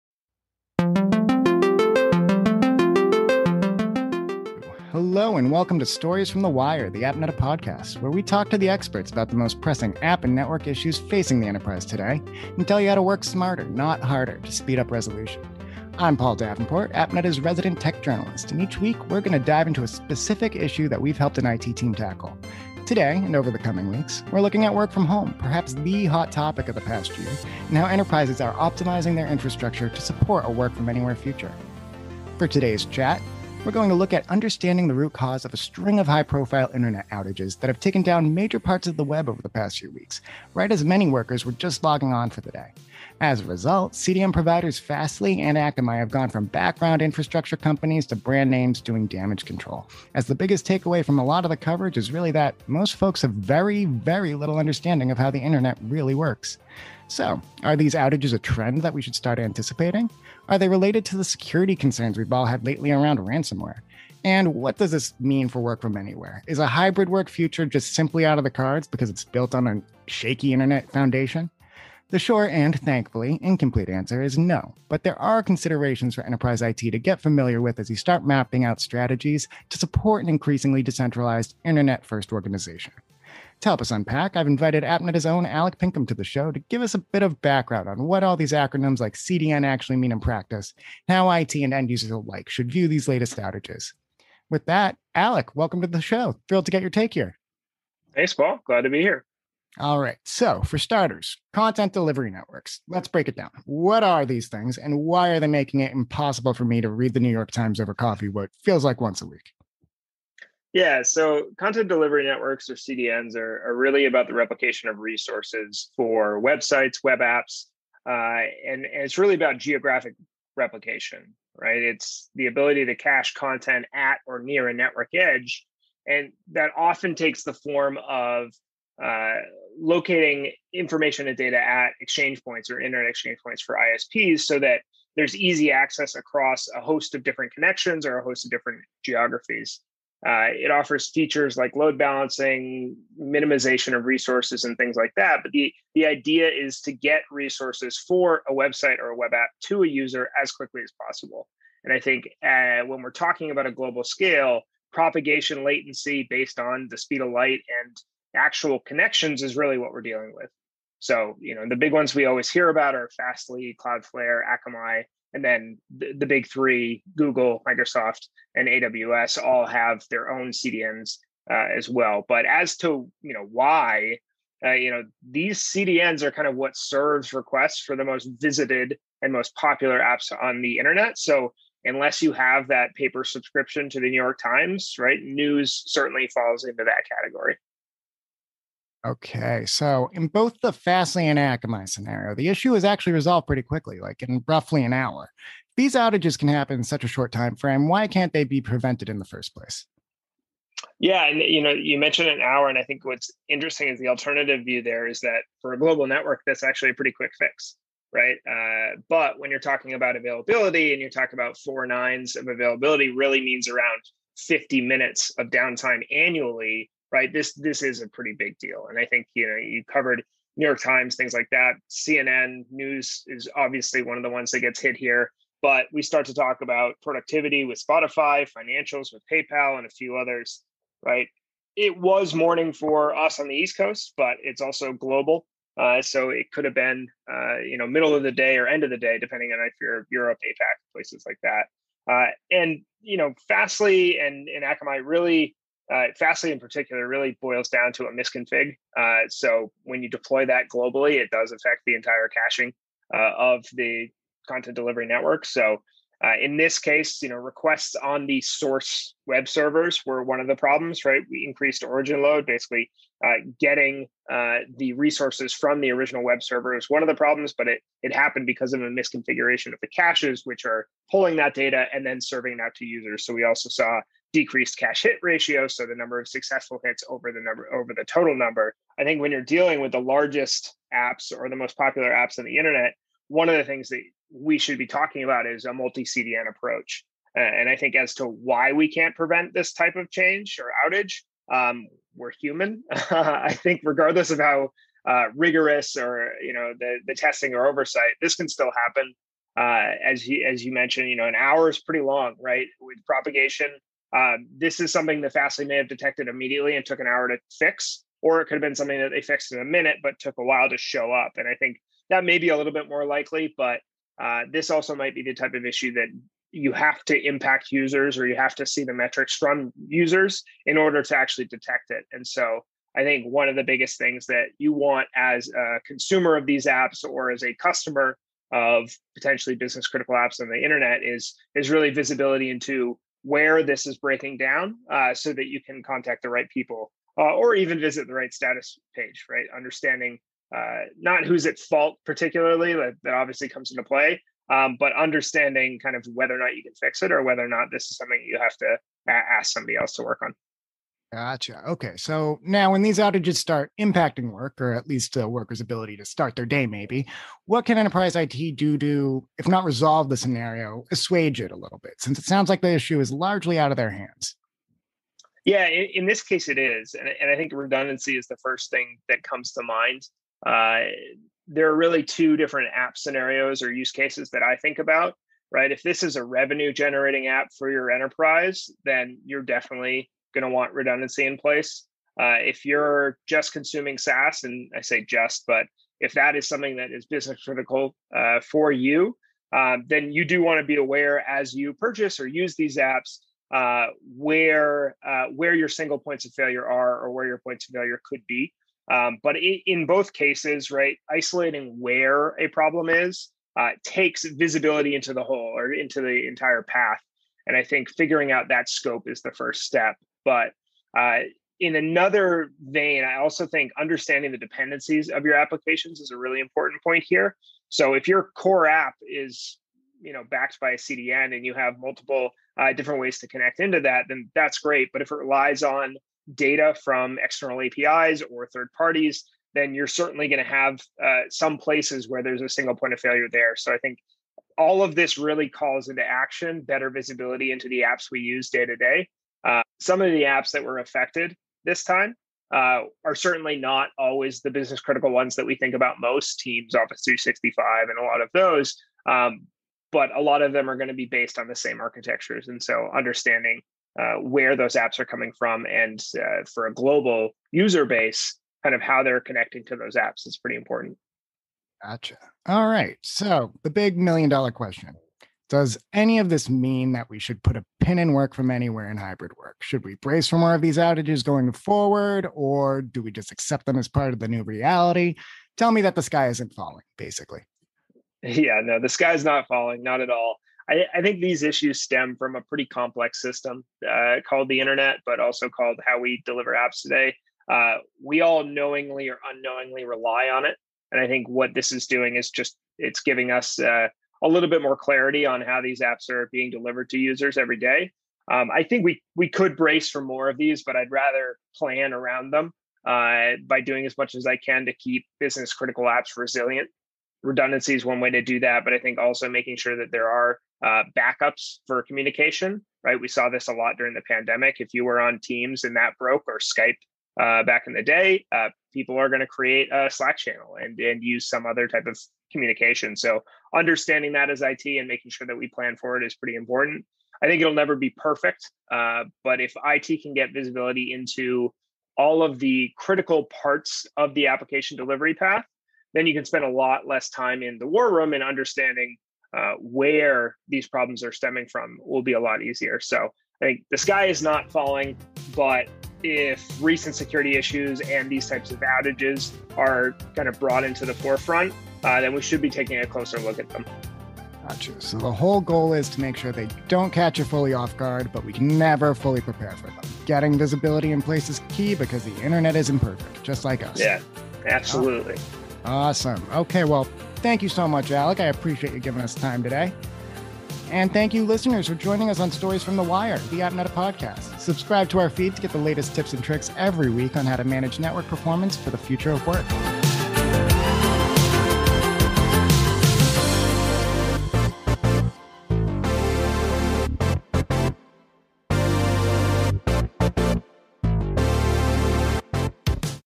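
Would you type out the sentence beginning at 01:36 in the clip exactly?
Thrilled to get your take here.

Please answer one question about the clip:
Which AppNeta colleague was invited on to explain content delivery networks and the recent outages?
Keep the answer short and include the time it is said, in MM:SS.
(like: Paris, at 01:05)
Alec Pinkham, at 01:25.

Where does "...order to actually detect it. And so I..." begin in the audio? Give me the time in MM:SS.
05:20.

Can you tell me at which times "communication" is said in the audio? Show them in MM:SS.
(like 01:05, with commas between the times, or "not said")
08:31, 08:42.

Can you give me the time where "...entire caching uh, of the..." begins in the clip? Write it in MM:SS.
04:11.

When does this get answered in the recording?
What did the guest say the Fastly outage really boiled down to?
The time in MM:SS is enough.
04:08.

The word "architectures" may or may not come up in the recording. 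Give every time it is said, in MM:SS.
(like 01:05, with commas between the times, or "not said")
07:31.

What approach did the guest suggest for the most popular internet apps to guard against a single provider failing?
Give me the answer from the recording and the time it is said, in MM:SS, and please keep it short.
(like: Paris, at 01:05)
Multi-CDN approach, at 04:45.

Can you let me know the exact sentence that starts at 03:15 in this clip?
these outages can happen in such a short time frame.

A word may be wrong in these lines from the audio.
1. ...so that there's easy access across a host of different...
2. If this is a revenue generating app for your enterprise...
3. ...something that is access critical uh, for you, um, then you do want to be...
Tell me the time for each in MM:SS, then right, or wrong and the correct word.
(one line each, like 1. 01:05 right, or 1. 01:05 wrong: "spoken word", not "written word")
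1. 02:14 right
2. 06:15 right
3. 06:26 wrong: "business", not "access".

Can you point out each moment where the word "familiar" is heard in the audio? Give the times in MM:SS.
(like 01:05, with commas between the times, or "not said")
01:17.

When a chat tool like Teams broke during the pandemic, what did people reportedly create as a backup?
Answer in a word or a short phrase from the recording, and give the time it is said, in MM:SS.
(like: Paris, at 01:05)
A Slack channel, at 08:39.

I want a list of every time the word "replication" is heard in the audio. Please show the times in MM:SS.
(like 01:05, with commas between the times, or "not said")
01:54, 02:00.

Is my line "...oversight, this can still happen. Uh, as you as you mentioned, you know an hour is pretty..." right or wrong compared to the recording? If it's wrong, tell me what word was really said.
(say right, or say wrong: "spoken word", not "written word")
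right.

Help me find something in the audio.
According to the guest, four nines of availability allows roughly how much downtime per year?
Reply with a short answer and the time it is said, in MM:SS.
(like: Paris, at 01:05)
50 minutes, at 03:34.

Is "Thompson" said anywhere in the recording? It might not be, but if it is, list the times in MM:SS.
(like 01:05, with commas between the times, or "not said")
not said.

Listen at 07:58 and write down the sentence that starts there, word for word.
Yeah, no, the sky's not falling, not at all.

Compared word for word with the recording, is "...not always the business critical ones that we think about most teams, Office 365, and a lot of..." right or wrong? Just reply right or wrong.
right.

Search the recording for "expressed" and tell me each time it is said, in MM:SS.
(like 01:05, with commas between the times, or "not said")
not said.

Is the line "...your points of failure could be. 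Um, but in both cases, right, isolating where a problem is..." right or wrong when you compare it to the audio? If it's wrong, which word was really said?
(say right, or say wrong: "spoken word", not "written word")
right.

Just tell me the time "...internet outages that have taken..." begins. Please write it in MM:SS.
00:36.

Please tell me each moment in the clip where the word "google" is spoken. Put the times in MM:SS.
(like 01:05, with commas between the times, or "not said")
02:47.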